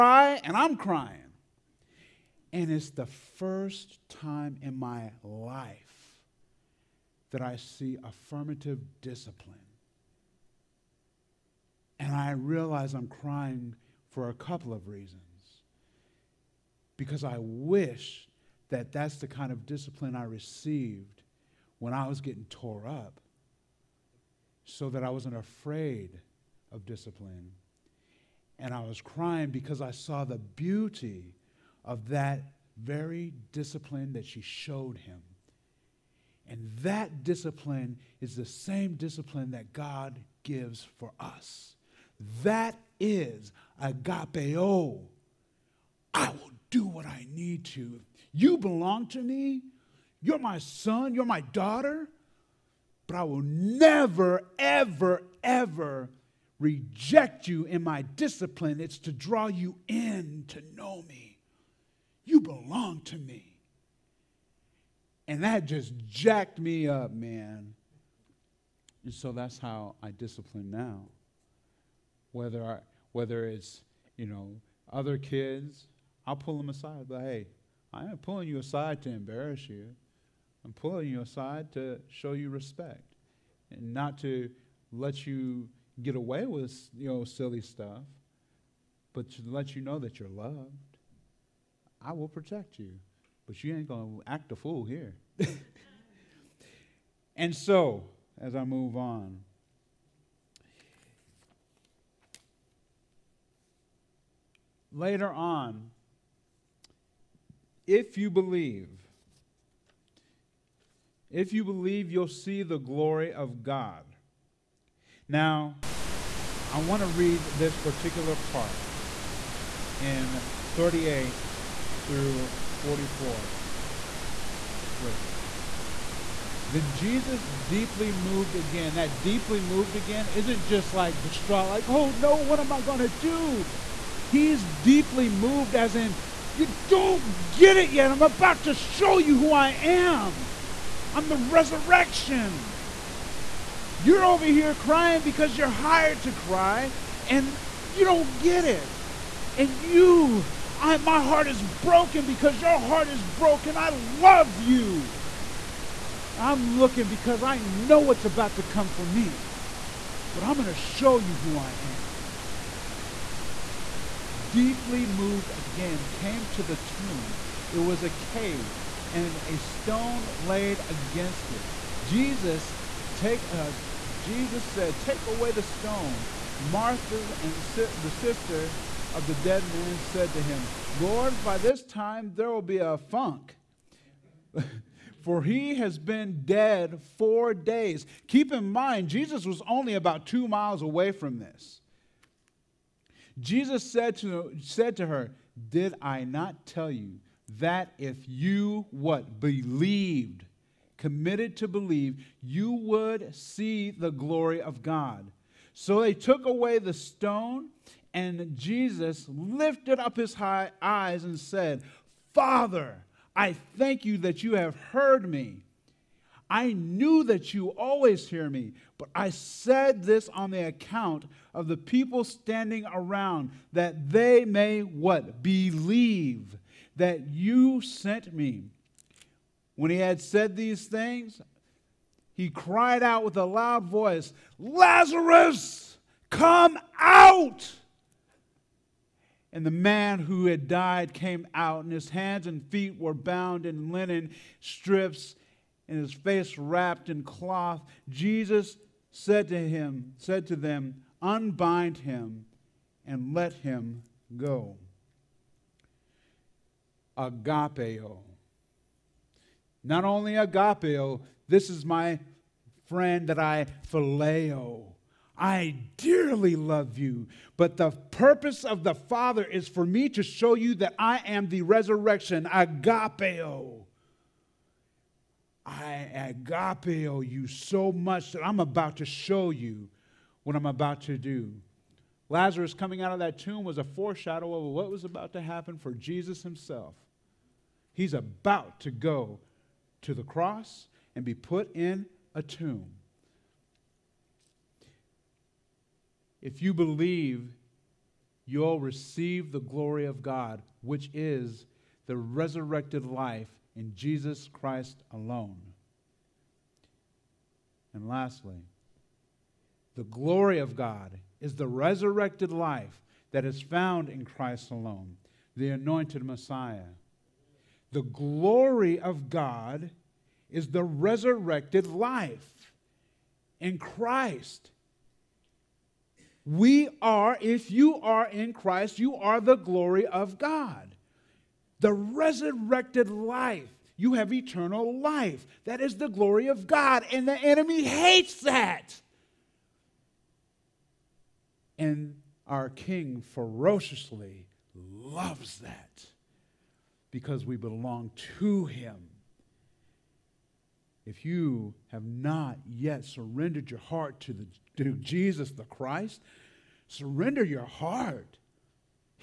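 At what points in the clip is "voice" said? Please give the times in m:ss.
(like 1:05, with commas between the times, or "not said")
3:53.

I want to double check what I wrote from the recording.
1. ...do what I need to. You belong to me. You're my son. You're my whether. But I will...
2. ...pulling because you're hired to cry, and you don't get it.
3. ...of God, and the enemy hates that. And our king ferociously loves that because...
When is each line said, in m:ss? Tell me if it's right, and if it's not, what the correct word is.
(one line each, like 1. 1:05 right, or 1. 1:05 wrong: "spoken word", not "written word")
1. 0:46 wrong: "daughter", not "whether"
2. 2:24 wrong: "crying", not "pulling"
3. 5:36 right.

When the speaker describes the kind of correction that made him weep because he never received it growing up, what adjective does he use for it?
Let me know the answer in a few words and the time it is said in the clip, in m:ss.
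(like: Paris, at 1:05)
affirmative, at 0:08.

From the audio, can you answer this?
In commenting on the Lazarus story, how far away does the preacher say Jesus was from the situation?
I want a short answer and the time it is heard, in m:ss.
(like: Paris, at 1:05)
about 2 miles, at 3:09.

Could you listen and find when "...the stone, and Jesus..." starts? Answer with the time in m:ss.
3:26.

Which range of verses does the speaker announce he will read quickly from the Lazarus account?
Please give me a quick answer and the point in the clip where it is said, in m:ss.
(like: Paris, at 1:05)
38 through 44, at 2:00.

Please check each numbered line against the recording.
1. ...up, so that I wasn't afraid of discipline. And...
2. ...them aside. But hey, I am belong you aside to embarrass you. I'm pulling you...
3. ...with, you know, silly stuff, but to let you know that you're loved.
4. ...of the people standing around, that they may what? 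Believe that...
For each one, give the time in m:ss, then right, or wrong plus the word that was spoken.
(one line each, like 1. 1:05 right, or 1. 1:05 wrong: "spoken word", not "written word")
1. 0:22 right
2. 1:16 wrong: "pulling", not "belong"
3. 1:26 right
4. 3:41 right.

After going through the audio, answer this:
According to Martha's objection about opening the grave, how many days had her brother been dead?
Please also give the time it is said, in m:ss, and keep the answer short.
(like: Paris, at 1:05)
4, at 3:07.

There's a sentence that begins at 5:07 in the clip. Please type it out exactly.
And lastly, the glory of God is the resurrected life that is found in Christ alone, the anointed Messiah.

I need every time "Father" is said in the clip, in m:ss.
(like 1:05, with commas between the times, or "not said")
3:32, 4:28.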